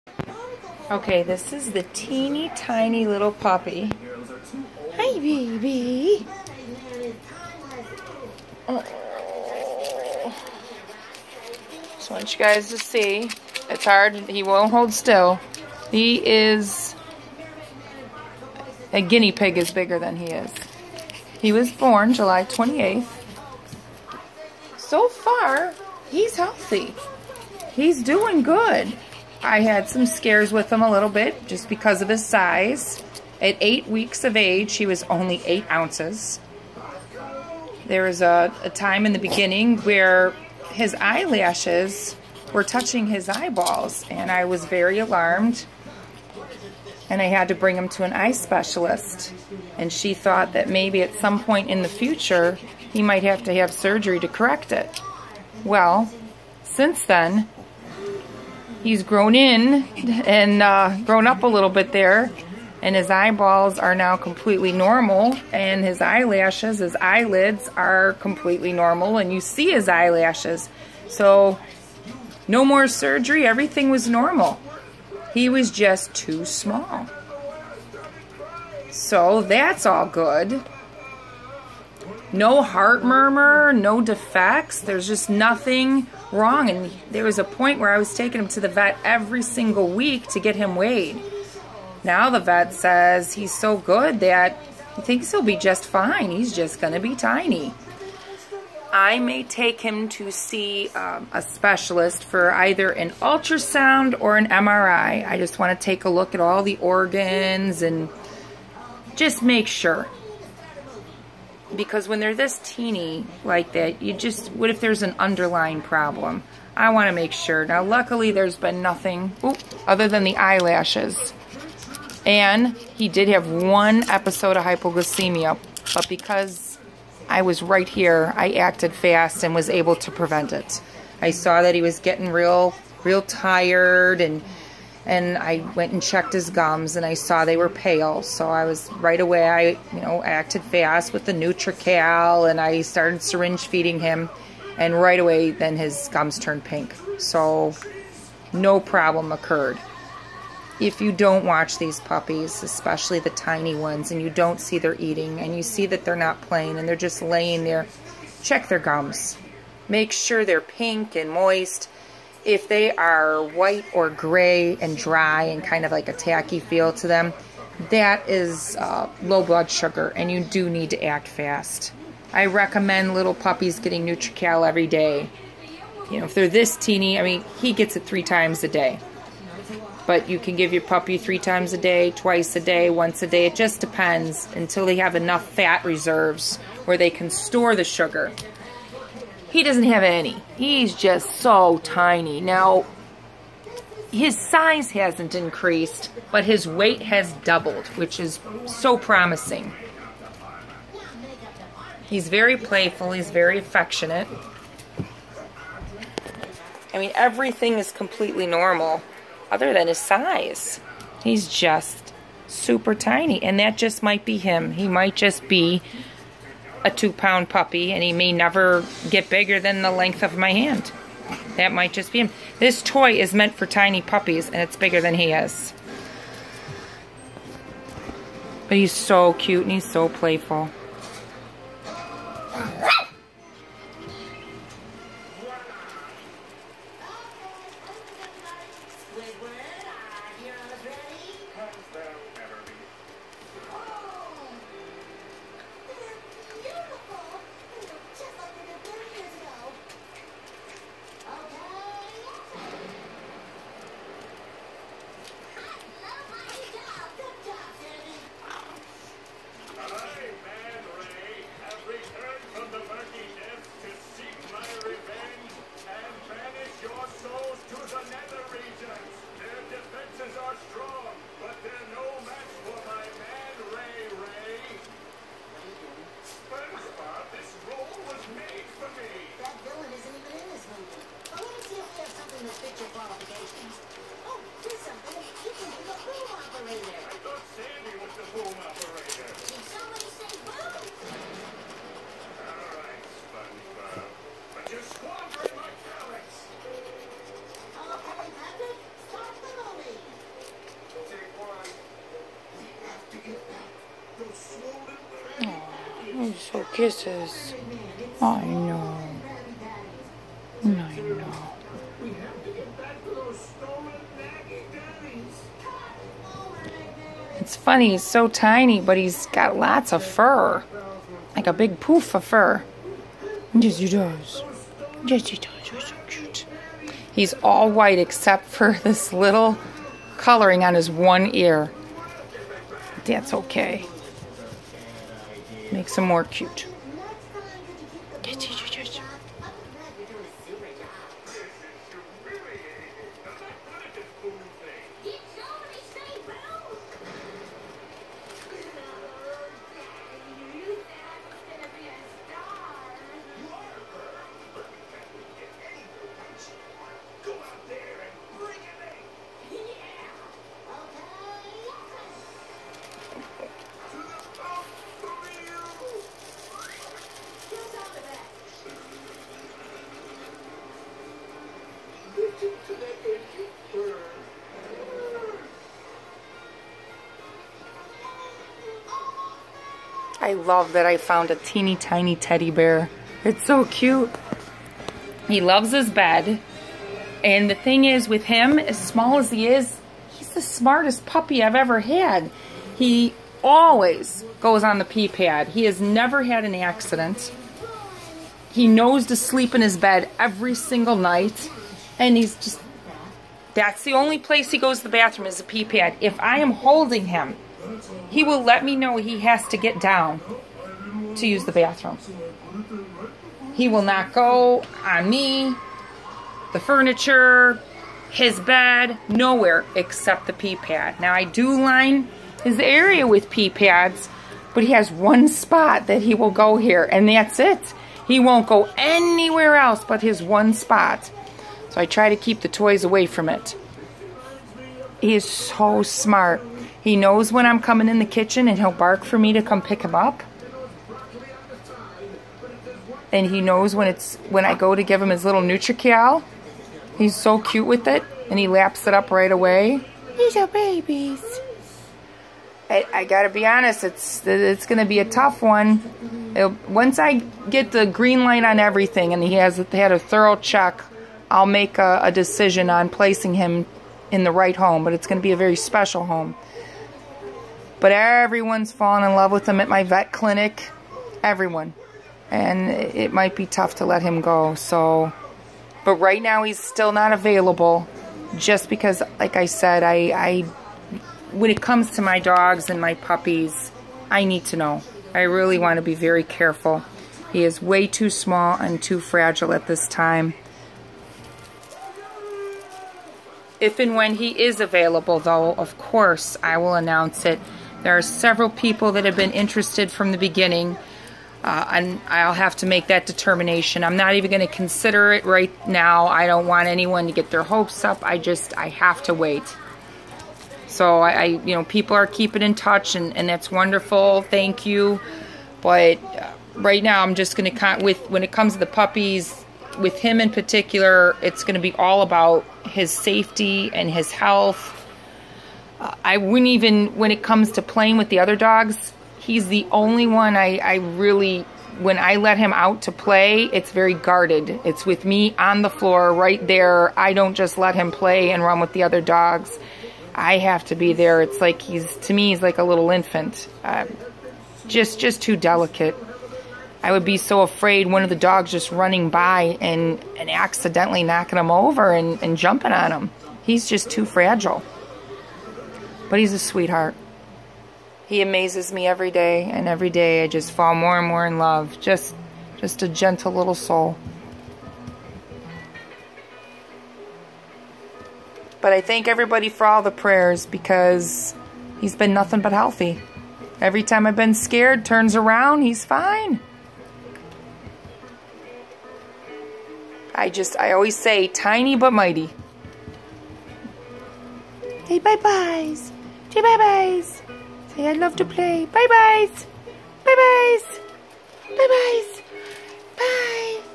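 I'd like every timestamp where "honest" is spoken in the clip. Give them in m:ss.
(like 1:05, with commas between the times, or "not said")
7:33.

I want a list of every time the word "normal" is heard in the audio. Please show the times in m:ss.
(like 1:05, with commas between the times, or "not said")
1:04, 1:08, 1:14, 3:28.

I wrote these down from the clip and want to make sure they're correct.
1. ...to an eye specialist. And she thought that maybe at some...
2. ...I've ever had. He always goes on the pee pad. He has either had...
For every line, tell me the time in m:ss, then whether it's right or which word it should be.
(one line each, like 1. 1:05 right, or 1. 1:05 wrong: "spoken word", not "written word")
1. 0:47 right
2. 6:31 wrong: "never", not "either".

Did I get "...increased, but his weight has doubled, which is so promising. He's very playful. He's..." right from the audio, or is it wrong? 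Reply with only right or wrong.
right.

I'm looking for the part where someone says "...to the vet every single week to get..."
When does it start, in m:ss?
1:28.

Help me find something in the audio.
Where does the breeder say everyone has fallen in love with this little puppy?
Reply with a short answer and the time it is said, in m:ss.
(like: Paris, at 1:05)
vet clinic, at 7:49.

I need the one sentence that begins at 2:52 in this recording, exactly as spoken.
I recommend little puppies getting NutriCal every day.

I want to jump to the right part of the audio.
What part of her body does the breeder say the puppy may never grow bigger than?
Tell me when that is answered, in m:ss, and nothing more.
3:39.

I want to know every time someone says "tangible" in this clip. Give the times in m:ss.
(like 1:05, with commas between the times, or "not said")
not said.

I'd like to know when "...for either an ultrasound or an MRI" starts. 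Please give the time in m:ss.
1:42.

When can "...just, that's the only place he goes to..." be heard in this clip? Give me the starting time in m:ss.
6:42.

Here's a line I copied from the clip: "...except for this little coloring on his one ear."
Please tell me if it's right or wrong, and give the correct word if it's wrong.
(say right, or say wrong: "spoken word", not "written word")
right.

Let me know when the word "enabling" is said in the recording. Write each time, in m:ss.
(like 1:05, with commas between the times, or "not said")
not said.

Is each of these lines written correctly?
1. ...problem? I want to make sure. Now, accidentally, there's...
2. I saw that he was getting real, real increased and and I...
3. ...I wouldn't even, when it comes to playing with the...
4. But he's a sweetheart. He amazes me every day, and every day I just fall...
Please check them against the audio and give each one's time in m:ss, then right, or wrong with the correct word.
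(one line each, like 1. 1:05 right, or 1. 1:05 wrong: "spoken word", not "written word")
1. 1:55 wrong: "luckily", not "accidentally"
2. 2:11 wrong: "tired", not "increased"
3. 8:46 right
4. 9:16 right.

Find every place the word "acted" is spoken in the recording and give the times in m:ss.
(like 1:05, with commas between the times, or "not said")
2:08, 2:20.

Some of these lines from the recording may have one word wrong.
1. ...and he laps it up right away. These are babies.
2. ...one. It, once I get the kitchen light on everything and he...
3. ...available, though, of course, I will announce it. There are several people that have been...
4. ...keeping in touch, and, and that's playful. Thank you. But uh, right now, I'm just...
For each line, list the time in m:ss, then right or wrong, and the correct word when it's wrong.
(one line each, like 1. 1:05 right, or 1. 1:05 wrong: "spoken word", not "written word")
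1. 7:28 right
2. 7:35 wrong: "green", not "kitchen"
3. 8:14 right
4. 8:32 wrong: "wonderful", not "playful".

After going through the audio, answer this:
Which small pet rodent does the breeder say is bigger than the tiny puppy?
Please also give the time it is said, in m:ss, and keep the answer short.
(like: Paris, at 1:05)
guinea pig, at 0:19.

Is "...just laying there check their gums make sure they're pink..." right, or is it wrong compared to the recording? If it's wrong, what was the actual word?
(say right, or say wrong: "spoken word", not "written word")
right.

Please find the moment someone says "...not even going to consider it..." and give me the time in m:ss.
8:23.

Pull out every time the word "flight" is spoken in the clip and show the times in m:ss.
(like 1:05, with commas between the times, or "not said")
not said.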